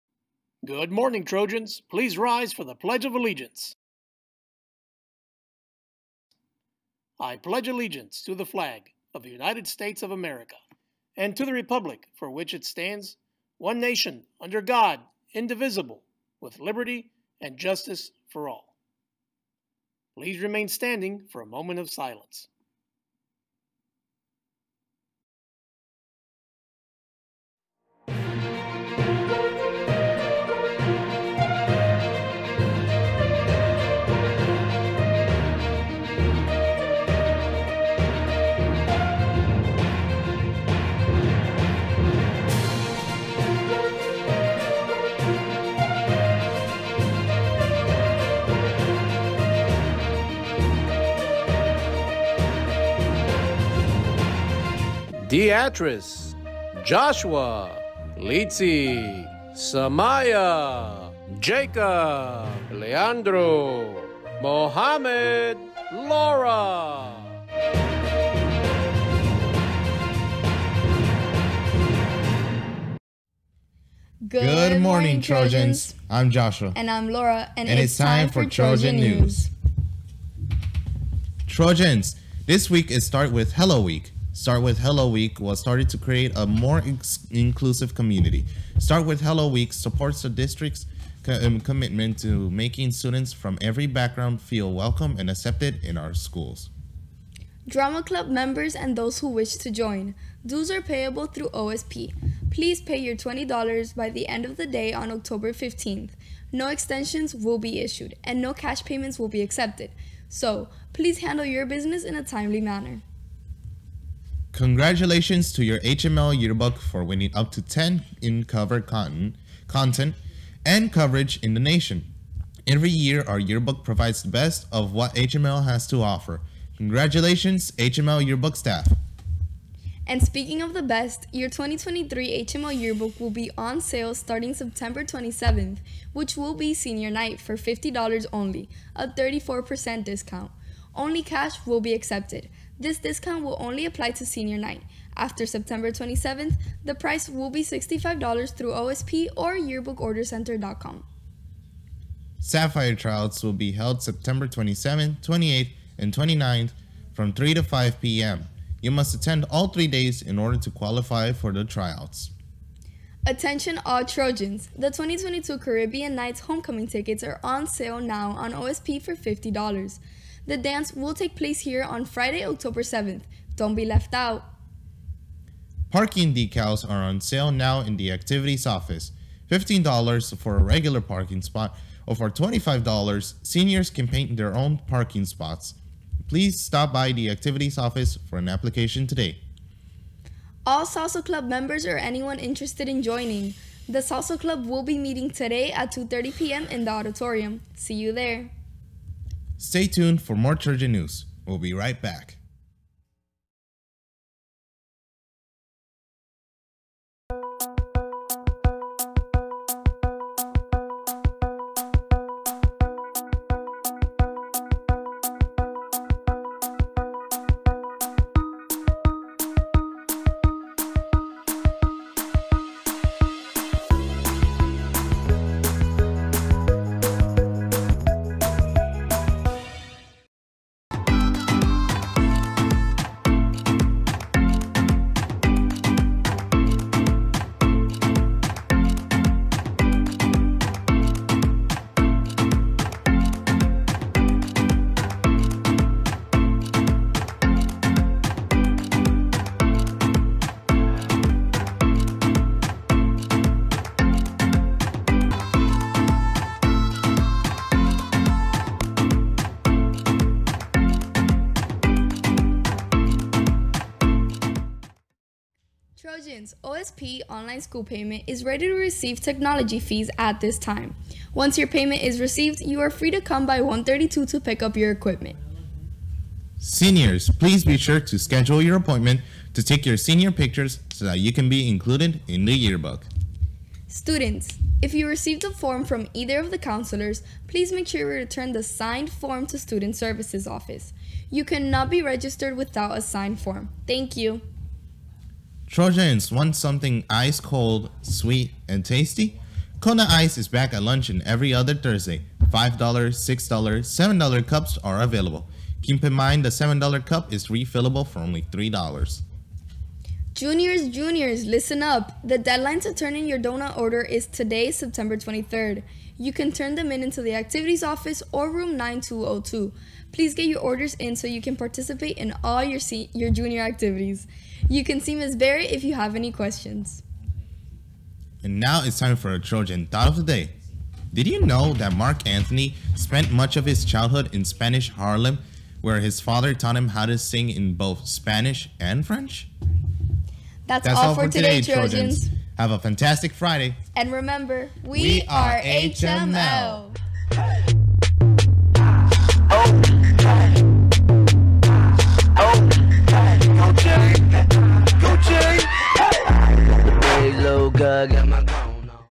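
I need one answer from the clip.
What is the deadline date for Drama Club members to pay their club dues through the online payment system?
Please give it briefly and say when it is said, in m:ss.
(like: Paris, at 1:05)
October 15th, at 1:45.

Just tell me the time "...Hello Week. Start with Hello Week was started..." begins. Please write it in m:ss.
1:23.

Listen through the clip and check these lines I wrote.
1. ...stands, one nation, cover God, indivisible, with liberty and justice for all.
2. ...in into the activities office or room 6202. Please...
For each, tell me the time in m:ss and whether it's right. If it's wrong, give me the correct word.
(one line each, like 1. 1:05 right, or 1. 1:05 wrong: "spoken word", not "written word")
1. 0:12 wrong: "under", not "cover"
2. 5:16 wrong: "9202", not "6202".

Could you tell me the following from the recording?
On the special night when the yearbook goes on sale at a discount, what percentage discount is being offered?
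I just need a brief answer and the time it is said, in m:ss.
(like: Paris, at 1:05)
34%, at 2:19.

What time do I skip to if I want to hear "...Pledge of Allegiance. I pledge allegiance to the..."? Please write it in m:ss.
0:02.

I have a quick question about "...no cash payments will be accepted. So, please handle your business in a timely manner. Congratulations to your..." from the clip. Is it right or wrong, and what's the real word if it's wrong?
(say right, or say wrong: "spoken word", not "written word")
right.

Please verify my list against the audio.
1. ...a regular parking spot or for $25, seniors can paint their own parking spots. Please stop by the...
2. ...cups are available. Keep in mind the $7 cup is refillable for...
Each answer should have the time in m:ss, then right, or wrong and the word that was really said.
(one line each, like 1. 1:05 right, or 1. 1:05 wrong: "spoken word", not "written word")
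1. 3:00 right
2. 5:04 right.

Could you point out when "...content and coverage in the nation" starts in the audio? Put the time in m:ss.
1:59.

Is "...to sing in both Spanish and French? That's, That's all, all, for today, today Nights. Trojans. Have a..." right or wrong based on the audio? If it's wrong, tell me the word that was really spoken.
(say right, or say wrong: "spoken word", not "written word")
wrong: "Trojans", not "Nights".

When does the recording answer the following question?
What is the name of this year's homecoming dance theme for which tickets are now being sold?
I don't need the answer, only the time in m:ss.
2:45.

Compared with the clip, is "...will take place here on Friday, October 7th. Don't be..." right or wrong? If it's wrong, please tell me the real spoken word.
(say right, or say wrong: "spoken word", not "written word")
right.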